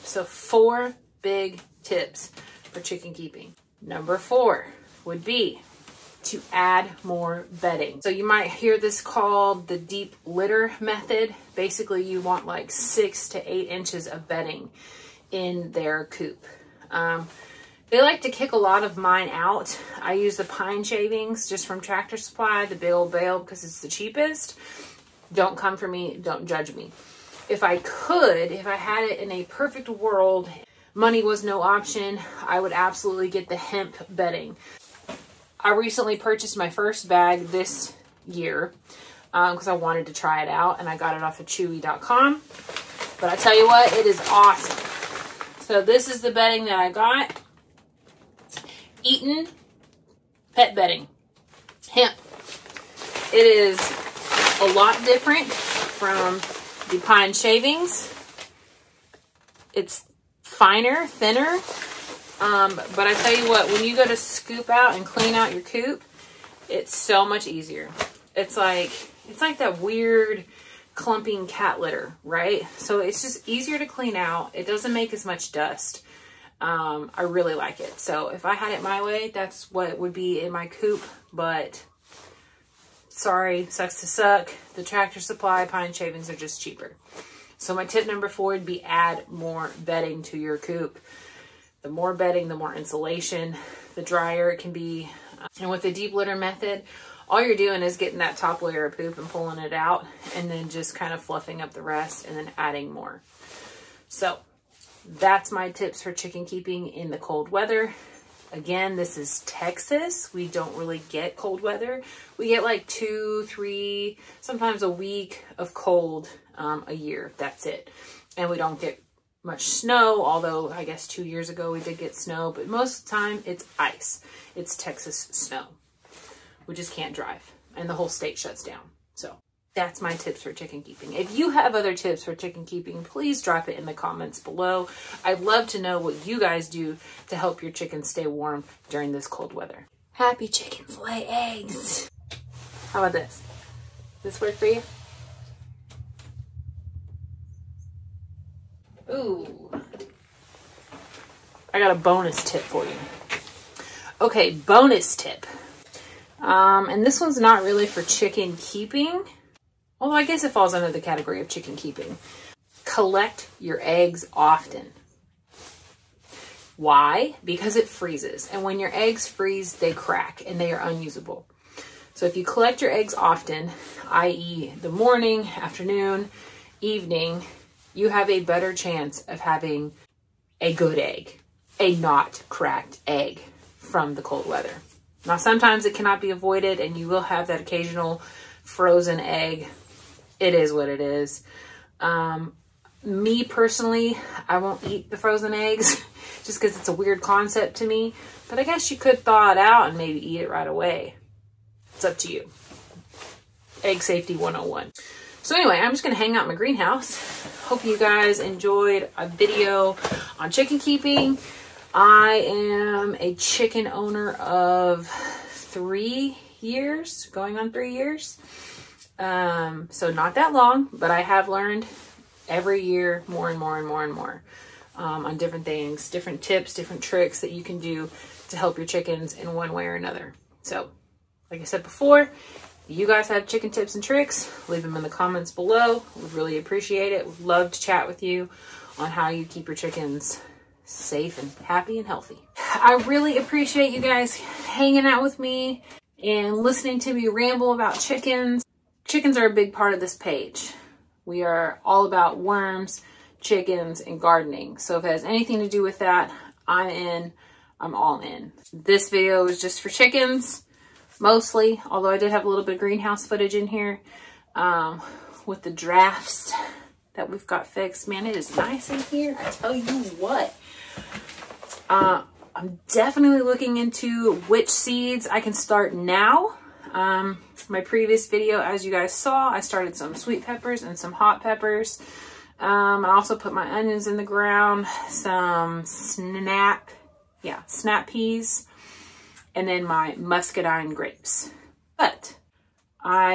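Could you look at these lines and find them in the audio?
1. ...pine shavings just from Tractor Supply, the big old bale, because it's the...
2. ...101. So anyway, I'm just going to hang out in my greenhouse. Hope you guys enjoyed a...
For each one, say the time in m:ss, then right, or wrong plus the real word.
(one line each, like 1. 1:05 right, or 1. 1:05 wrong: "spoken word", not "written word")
1. 0:20 right
2. 3:24 right.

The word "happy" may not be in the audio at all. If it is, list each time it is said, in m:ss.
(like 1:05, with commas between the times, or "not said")
2:20, 4:01.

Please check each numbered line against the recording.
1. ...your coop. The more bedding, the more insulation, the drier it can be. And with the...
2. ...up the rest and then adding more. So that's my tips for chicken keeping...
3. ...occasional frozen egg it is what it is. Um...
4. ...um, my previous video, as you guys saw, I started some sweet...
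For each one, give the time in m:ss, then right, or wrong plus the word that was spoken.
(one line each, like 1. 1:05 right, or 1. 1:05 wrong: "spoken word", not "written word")
1. 1:30 right
2. 1:41 right
3. 3:07 right
4. 4:36 right.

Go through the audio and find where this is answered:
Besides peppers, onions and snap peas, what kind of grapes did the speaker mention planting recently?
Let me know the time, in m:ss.
4:50.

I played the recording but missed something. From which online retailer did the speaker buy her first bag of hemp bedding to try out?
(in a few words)
Chewy.com.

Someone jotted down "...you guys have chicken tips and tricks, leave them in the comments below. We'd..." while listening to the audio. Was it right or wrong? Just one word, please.
right.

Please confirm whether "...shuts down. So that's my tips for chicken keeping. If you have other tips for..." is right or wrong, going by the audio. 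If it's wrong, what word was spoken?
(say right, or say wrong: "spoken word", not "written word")
right.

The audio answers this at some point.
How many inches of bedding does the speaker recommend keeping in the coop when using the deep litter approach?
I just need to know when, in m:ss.
0:12.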